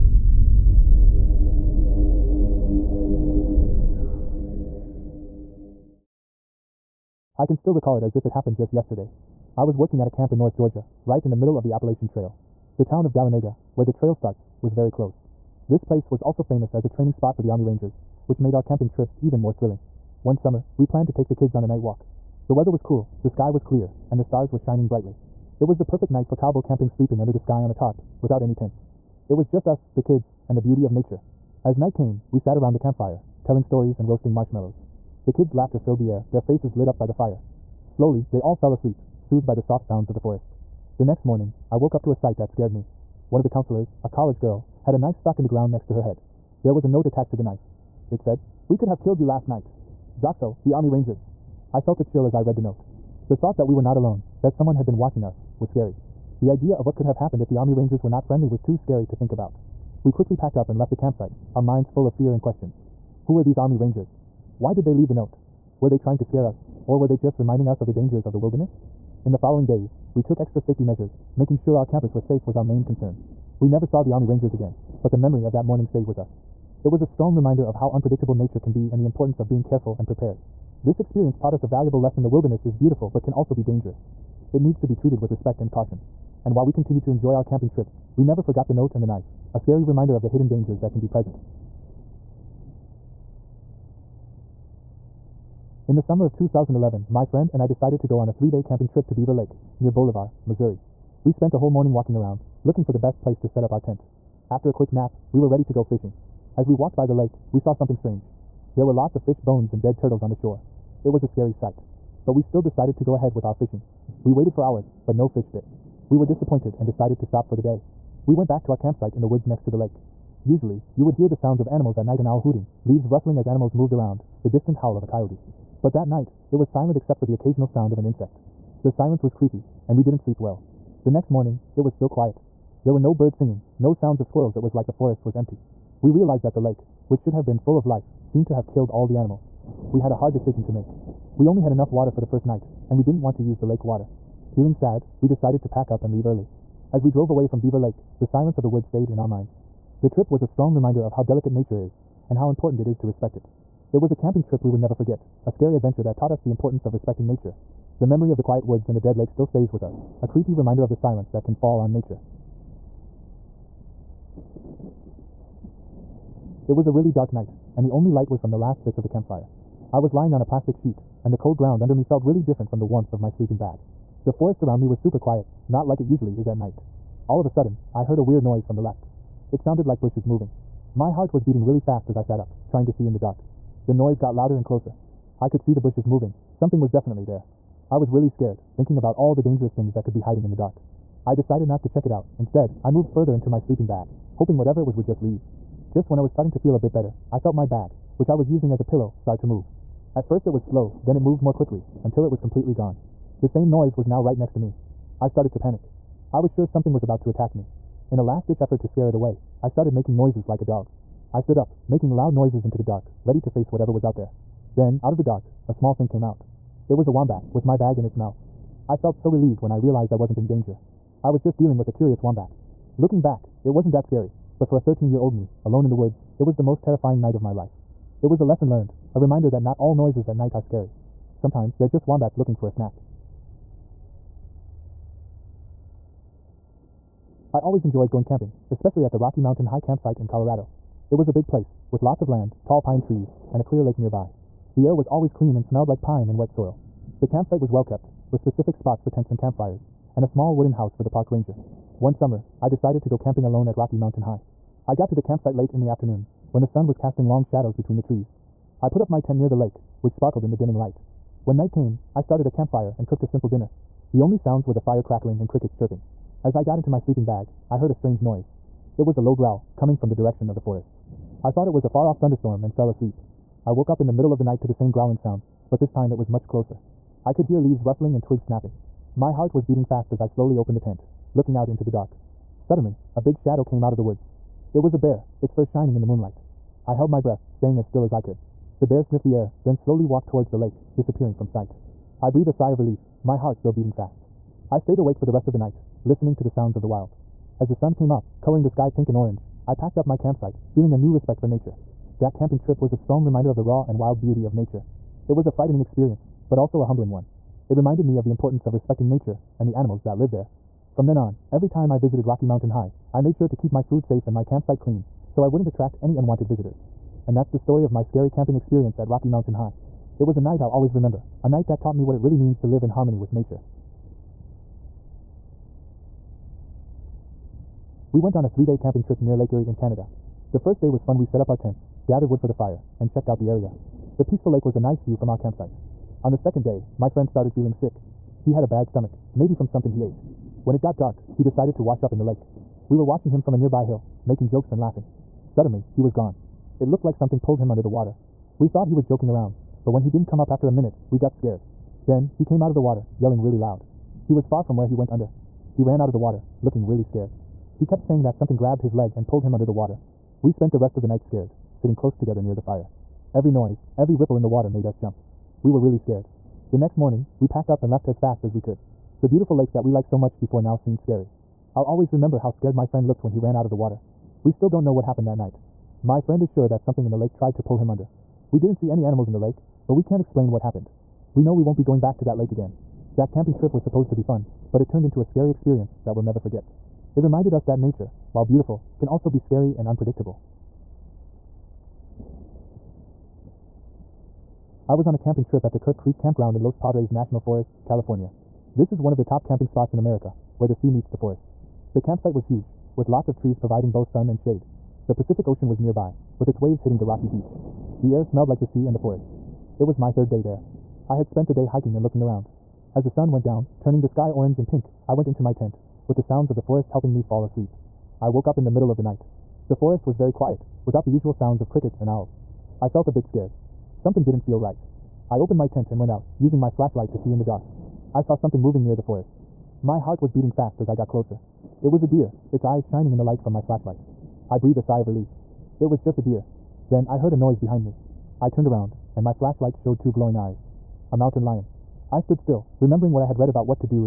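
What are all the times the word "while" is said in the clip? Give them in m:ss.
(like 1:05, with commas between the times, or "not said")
1:26, 6:28.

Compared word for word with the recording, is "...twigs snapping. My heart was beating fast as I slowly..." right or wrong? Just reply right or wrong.
right.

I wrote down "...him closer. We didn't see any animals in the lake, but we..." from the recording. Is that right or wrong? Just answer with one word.
wrong.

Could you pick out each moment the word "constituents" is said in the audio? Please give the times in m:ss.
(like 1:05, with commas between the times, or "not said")
not said.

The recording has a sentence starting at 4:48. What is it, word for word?
The bear sniffed the air, then slowly walked towards the lake, disappearing from sight.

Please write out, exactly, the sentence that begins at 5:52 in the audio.
Then, he came out of the water, yelling really loud.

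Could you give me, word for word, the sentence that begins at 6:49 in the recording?
It was my third day there.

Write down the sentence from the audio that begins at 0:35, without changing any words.
The kids' laughter filled the air, their faces lit up by the fire.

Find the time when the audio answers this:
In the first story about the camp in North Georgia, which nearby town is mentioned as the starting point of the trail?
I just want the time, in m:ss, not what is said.
0:13.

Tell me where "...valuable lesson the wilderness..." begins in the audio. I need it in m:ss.
1:21.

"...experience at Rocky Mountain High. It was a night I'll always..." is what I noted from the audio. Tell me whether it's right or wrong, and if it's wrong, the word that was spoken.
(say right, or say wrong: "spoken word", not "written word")
right.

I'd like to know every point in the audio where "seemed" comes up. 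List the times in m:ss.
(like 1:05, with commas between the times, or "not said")
2:18, 6:10.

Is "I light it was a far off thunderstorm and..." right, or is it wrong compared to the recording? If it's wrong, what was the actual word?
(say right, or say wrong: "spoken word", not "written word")
wrong: "thought", not "light".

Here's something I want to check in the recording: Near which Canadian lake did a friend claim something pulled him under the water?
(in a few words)
Lake Erie.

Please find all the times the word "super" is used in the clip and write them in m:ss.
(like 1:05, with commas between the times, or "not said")
2:54.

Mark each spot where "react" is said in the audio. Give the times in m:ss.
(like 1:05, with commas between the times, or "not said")
not said.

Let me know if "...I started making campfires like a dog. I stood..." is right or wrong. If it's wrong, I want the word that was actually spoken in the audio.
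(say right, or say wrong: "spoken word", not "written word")
wrong: "noises", not "campfires".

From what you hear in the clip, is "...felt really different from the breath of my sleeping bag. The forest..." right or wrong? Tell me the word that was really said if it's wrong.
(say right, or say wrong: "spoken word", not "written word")
wrong: "warmth", not "breath".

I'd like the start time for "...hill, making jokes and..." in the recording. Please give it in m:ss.
5:43.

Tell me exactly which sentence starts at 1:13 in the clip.
We never saw the Army Rangers again, but the memory of that morning stayed with us.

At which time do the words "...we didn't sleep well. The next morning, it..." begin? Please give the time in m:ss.
2:09.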